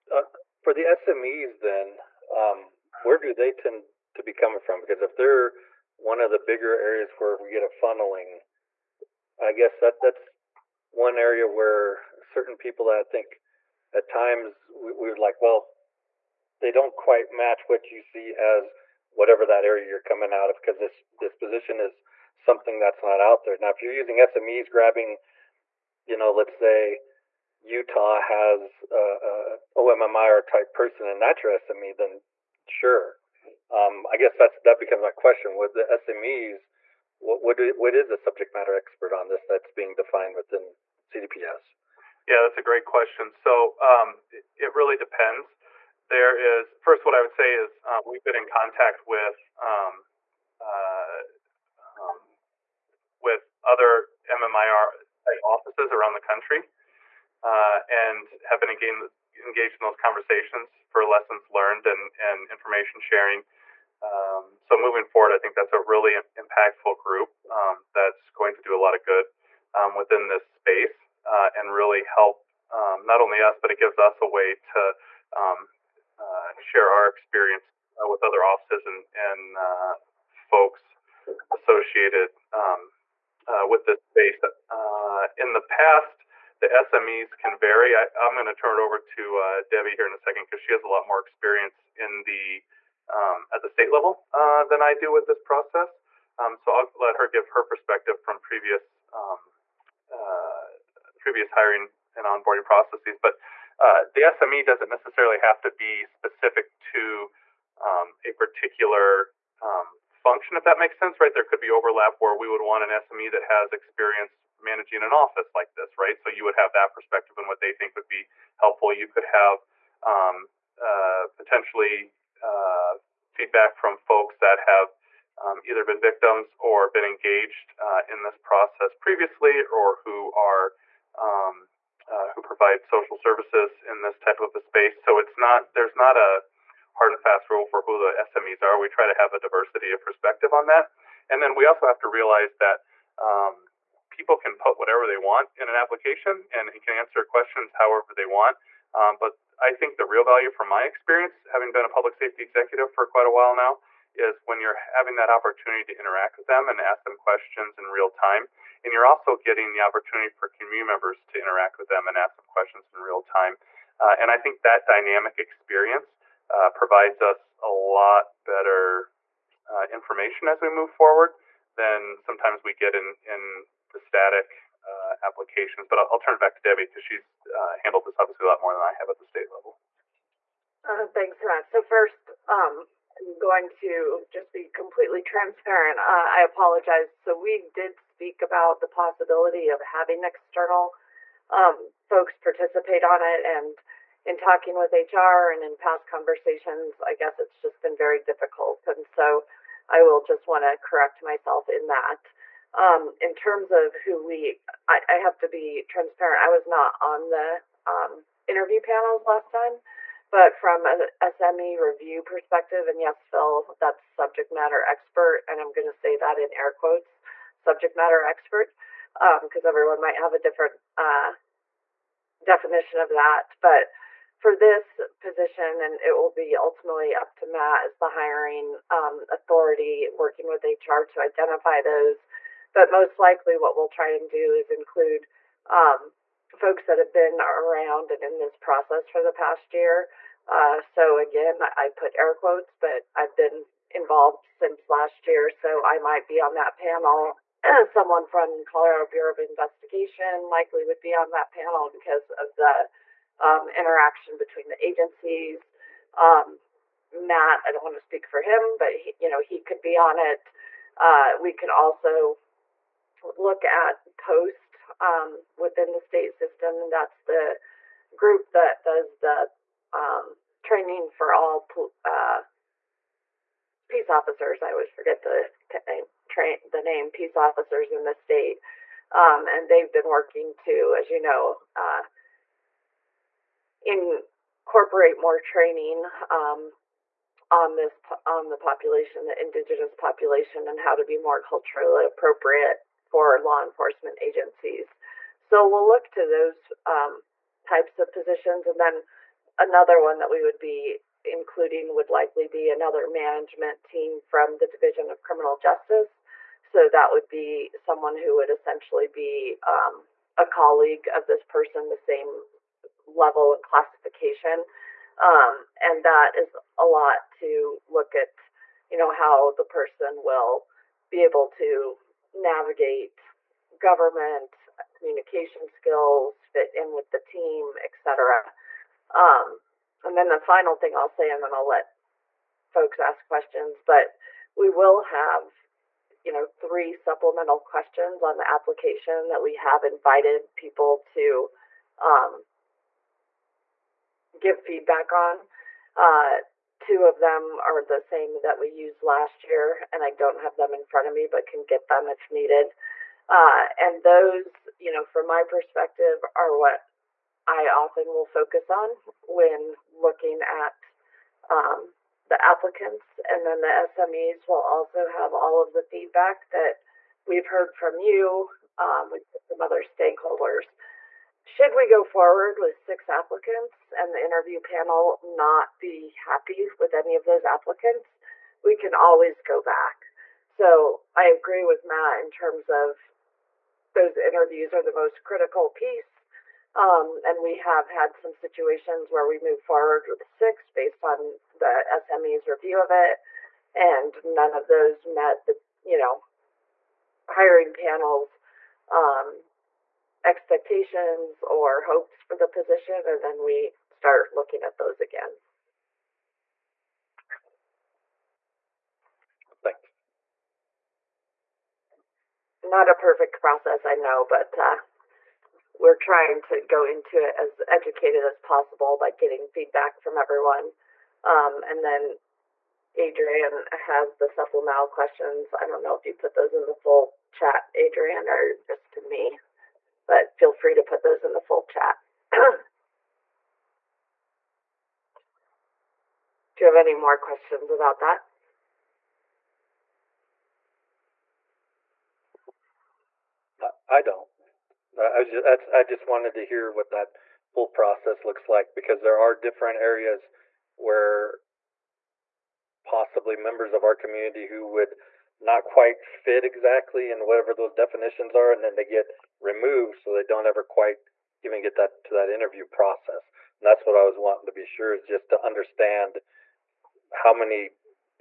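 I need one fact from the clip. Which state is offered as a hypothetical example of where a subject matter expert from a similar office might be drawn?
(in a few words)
Utah.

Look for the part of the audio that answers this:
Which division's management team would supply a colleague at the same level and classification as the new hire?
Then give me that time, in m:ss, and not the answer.
5:04.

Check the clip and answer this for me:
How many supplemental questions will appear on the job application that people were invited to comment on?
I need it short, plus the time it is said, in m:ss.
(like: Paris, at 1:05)
3, at 5:36.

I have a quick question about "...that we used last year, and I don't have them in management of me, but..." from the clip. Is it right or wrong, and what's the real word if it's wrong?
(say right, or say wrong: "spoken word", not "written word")
wrong: "front", not "management".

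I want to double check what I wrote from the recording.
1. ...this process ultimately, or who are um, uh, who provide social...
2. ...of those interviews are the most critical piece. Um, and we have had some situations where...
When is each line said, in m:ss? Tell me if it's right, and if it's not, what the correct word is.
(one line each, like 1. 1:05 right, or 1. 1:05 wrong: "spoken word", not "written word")
1. 2:08 wrong: "previously", not "ultimately"
2. 6:22 right.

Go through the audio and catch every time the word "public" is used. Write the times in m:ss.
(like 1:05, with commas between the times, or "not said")
2:31.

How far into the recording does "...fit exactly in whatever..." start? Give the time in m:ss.
7:36.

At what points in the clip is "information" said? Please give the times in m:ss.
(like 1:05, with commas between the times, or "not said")
1:02, 2:49.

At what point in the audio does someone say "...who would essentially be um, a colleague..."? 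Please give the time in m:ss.
5:08.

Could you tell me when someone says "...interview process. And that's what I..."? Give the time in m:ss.
7:42.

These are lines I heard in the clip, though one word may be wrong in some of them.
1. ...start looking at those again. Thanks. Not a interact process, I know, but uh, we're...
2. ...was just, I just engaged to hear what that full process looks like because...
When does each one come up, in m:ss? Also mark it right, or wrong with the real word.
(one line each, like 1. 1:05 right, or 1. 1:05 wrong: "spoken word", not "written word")
1. 6:43 wrong: "perfect", not "interact"
2. 7:25 wrong: "wanted", not "engaged".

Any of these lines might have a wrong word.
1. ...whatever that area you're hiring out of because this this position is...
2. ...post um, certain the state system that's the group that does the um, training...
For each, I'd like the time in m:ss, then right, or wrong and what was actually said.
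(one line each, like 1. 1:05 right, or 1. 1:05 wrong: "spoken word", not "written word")
1. 0:19 wrong: "coming", not "hiring"
2. 4:24 wrong: "within", not "certain".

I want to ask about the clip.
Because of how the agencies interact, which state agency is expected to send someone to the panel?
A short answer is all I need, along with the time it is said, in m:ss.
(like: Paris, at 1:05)
Colorado Bureau of Investigation, at 4:08.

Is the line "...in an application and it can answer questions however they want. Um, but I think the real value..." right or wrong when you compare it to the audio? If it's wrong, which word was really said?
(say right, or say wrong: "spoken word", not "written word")
right.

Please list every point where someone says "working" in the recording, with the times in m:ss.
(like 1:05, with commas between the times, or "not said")
3:50, 4:40.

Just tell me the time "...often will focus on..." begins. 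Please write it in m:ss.
5:57.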